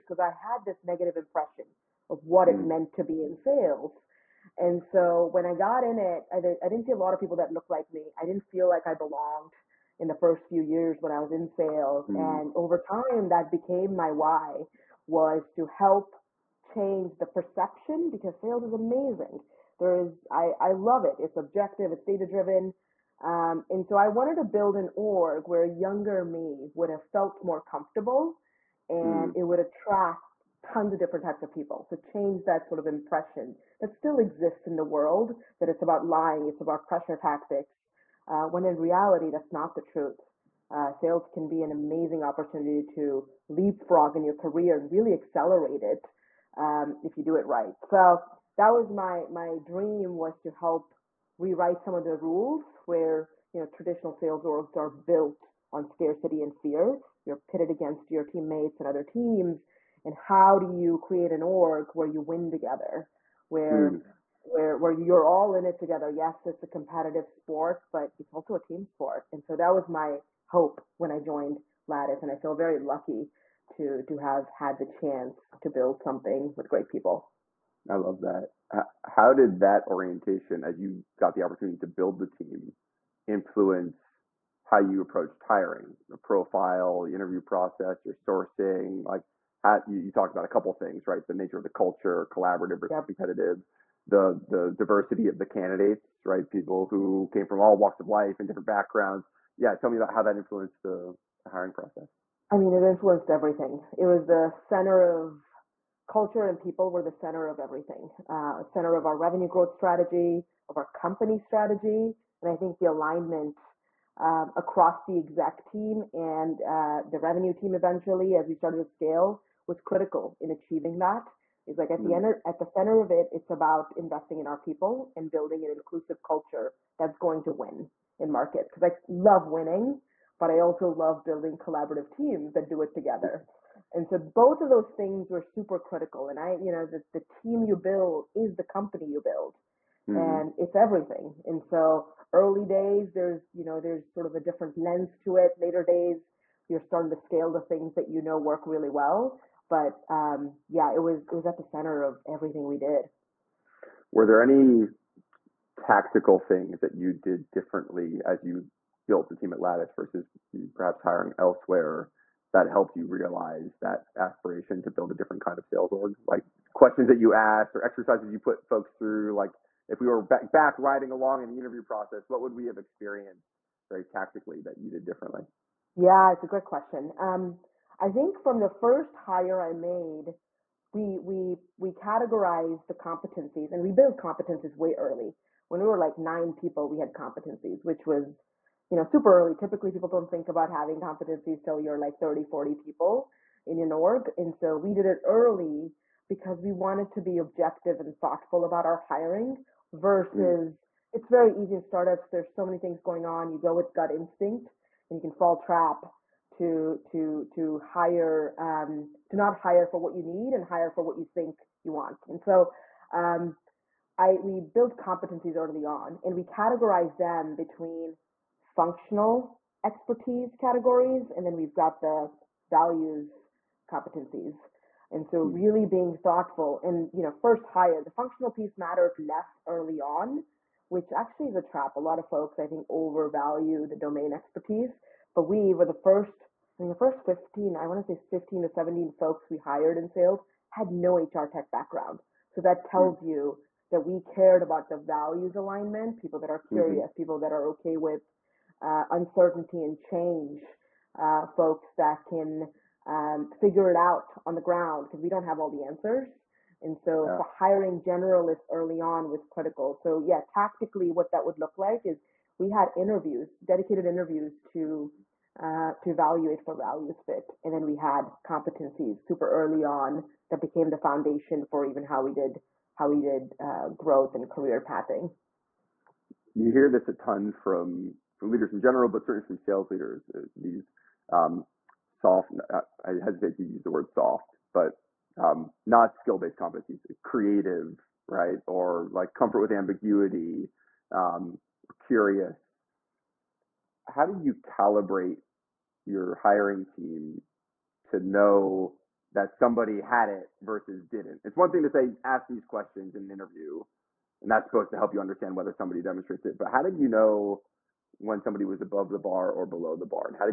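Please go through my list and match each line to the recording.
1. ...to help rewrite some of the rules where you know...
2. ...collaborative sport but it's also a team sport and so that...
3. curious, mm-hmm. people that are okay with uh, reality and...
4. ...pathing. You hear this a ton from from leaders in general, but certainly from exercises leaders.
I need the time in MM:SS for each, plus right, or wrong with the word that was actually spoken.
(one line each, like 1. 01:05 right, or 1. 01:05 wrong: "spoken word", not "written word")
1. 00:50 right
2. 01:06 wrong: "competitive", not "collaborative"
3. 04:06 wrong: "uncertainty", not "reality"
4. 04:34 wrong: "sales", not "exercises".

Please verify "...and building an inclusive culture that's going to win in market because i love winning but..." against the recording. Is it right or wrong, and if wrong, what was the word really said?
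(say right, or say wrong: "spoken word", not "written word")
right.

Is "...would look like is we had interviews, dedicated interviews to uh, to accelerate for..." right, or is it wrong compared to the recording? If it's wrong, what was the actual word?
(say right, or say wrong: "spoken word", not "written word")
wrong: "evaluate", not "accelerate".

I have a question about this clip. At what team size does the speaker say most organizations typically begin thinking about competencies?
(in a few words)
30 to 40 people.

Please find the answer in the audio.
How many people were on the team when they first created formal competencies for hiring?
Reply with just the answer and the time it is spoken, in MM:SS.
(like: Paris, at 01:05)
9, at 03:06.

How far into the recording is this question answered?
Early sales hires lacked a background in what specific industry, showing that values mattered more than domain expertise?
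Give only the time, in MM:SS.
04:01.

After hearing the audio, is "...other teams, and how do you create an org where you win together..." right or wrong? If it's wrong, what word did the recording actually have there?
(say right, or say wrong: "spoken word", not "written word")
right.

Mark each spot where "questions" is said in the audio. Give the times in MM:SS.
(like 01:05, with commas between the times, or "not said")
02:46, 02:56, 05:02.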